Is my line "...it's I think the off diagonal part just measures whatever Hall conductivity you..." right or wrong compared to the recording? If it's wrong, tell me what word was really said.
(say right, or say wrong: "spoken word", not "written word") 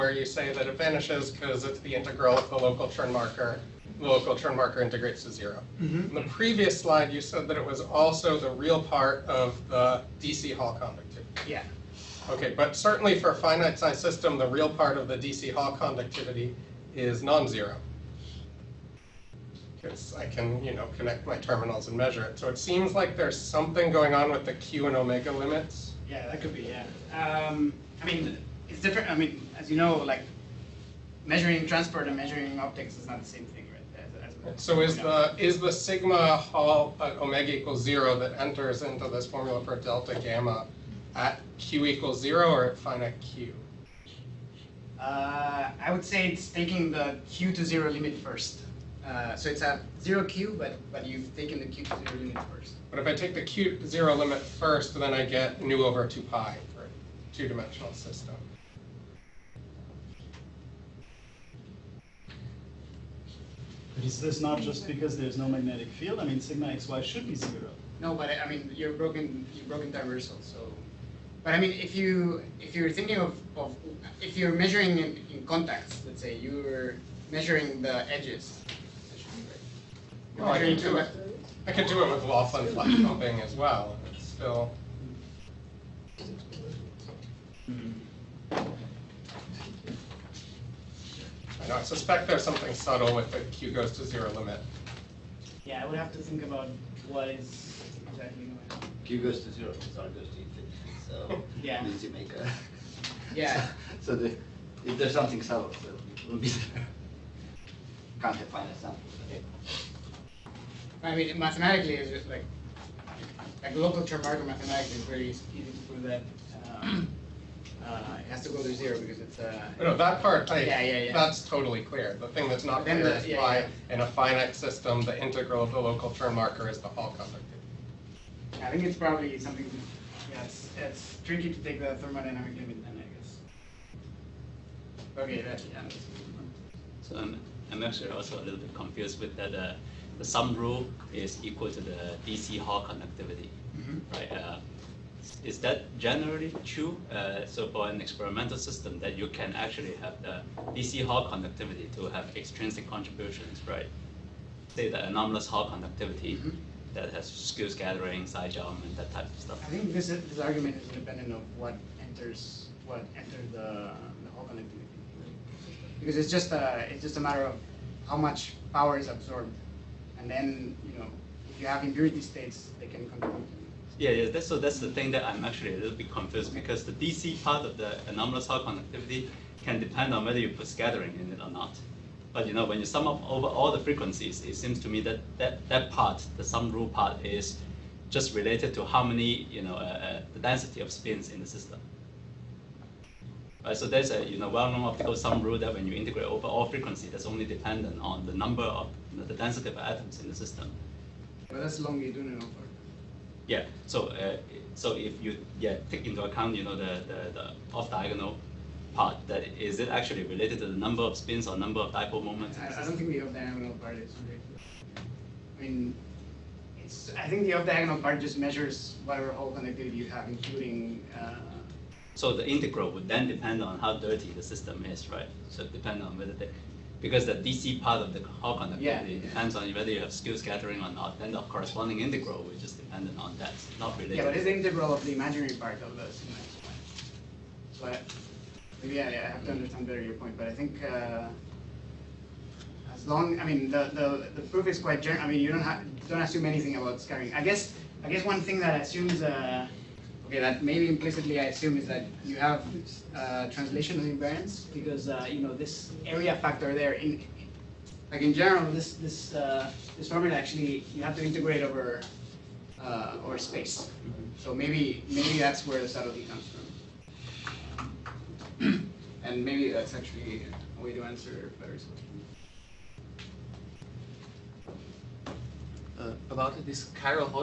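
right.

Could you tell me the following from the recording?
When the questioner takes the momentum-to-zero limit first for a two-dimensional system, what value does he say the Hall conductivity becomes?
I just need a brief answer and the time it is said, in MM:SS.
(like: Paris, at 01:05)
nu over 2 pi, at 00:55.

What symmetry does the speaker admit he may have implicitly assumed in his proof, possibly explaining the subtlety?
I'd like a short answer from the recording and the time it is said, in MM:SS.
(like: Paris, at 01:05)
translational invariance, at 04:13.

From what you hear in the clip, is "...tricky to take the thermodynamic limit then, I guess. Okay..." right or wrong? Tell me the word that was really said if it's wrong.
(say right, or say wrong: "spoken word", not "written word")
right.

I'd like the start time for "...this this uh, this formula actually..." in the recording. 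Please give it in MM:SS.
04:18.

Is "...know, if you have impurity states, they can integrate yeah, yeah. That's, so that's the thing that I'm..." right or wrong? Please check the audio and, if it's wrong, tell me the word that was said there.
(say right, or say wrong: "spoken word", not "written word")
wrong: "contribute", not "integrate".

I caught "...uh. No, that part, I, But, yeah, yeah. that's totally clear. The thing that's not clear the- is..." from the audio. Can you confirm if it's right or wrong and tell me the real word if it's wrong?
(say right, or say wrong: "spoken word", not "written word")
wrong: "Yeah", not "But".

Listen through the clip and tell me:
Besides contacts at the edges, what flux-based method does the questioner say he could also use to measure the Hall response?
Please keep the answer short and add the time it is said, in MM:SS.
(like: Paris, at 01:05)
Laughlin flux pumping, at 01:22.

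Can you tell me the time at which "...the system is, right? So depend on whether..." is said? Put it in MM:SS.
03:44.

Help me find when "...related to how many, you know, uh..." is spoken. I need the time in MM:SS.
03:08.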